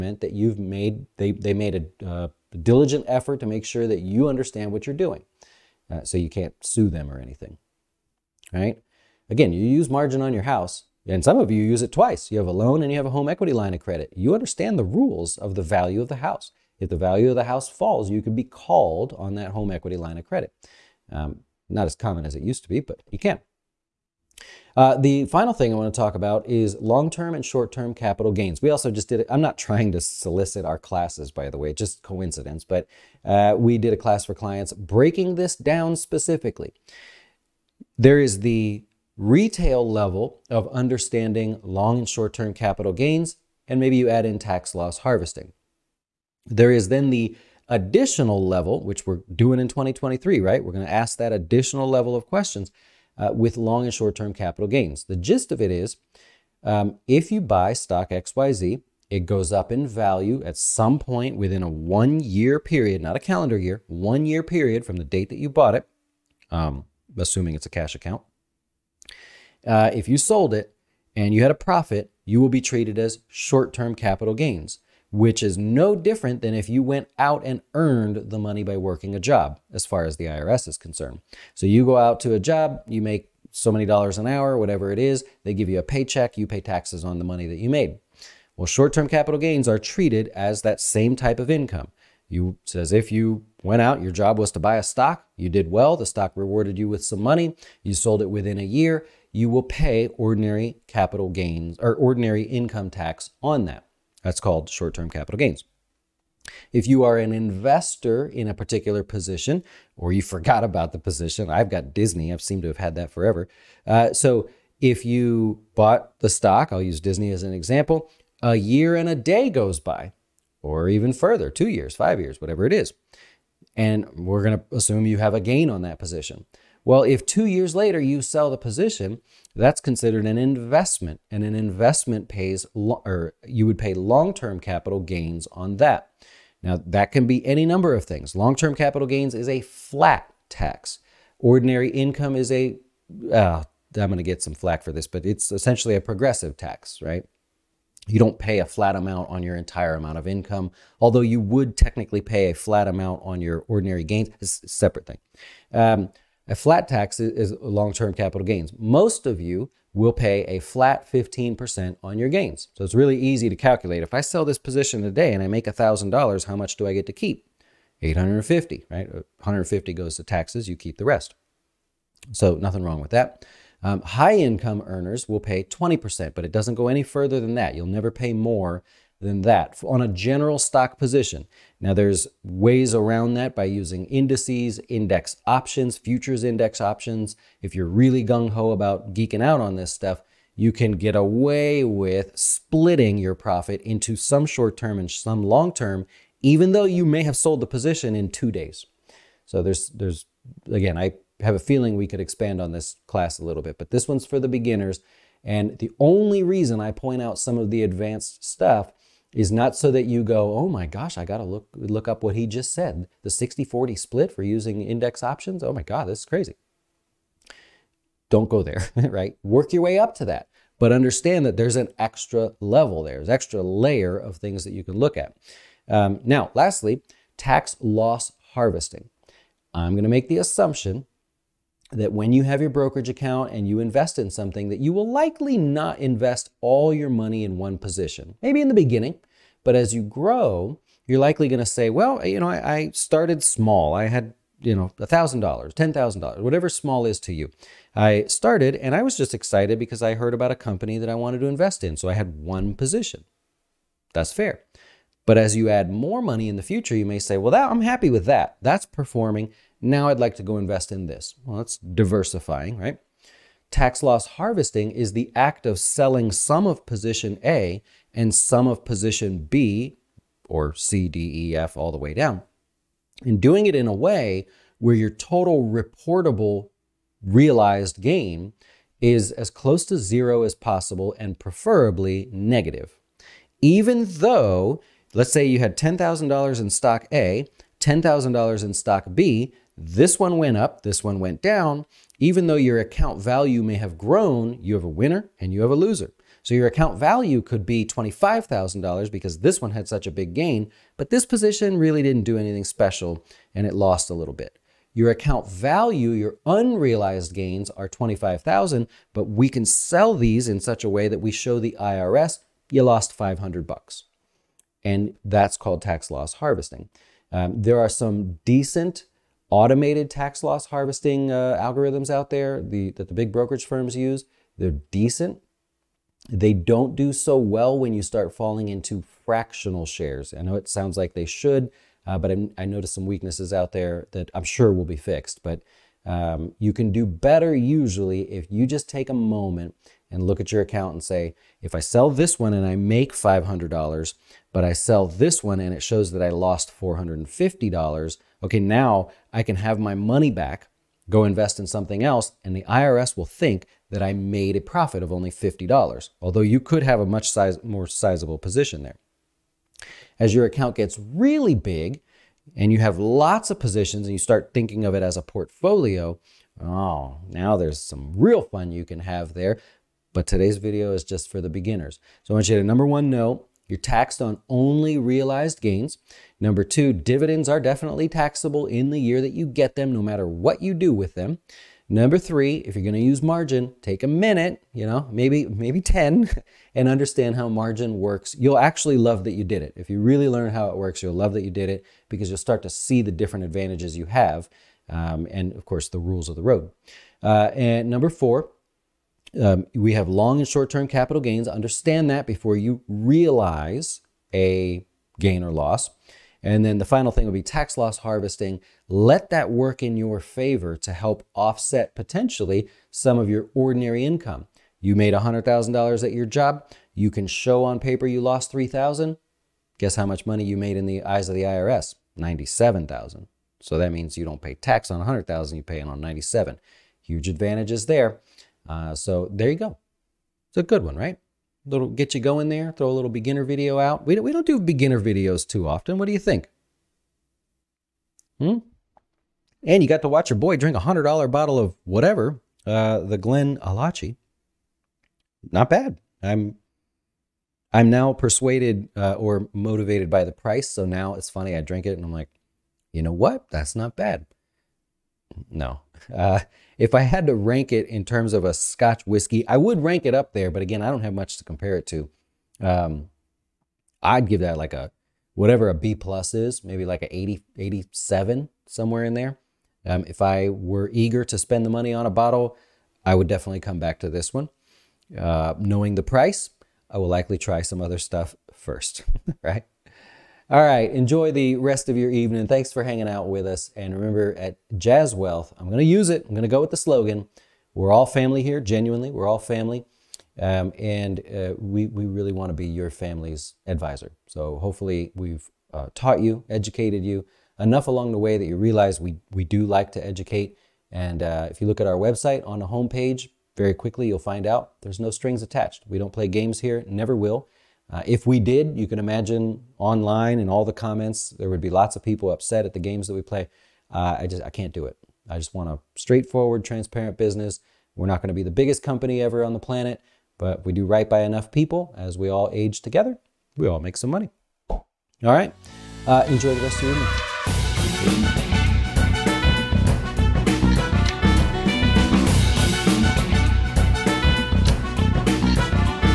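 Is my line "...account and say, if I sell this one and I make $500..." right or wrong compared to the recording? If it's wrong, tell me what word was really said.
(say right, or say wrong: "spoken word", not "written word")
right.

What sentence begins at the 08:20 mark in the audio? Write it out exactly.
And uh, if you look at our website on the homepage, very quickly you'll find out there's no strings attached.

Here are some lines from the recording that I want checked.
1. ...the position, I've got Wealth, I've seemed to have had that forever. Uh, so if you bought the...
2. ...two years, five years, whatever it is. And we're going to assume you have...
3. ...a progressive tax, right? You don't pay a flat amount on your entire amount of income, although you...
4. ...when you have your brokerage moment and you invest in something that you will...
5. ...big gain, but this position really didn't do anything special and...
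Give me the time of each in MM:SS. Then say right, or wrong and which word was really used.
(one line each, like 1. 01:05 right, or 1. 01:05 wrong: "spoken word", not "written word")
1. 01:50 wrong: "Disney", not "Wealth"
2. 02:01 right
3. 02:25 right
4. 03:52 wrong: "account", not "moment"
5. 05:00 right.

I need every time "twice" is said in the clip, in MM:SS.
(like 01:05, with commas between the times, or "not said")
00:11.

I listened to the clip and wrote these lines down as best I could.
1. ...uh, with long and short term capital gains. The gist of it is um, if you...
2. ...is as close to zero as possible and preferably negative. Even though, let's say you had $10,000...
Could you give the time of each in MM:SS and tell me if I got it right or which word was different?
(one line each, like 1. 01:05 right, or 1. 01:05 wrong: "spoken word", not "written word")
1. 00:53 right
2. 04:39 right.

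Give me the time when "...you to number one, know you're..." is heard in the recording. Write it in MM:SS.
06:12.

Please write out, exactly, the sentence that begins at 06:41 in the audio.
Understand that before you realize a gain or loss.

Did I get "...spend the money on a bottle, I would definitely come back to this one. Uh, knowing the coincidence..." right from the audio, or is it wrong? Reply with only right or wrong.
wrong.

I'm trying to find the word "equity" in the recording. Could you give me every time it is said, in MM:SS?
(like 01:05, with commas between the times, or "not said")
00:13, 00:19.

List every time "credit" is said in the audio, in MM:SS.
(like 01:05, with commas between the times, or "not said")
00:13, 00:20.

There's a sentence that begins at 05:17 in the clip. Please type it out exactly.
Um, there are some decent automated tax loss harvesting uh, algorithms out there the, that the big brokerage firms use.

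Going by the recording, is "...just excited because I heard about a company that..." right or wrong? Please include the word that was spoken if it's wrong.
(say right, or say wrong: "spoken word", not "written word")
right.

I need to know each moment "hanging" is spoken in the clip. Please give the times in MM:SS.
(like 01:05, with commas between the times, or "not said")
08:02.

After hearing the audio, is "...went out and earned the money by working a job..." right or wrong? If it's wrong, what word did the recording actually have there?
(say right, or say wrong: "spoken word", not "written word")
right.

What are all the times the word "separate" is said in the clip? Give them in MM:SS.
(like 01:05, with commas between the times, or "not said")
02:34.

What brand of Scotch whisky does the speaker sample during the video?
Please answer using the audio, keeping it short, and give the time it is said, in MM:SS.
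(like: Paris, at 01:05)
GlenAllachie, at 07:23.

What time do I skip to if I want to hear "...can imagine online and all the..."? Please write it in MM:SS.
08:28.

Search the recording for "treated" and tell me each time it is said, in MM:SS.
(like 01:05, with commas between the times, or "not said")
01:12, 01:29.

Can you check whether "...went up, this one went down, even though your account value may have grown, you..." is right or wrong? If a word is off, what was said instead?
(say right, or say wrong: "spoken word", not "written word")
right.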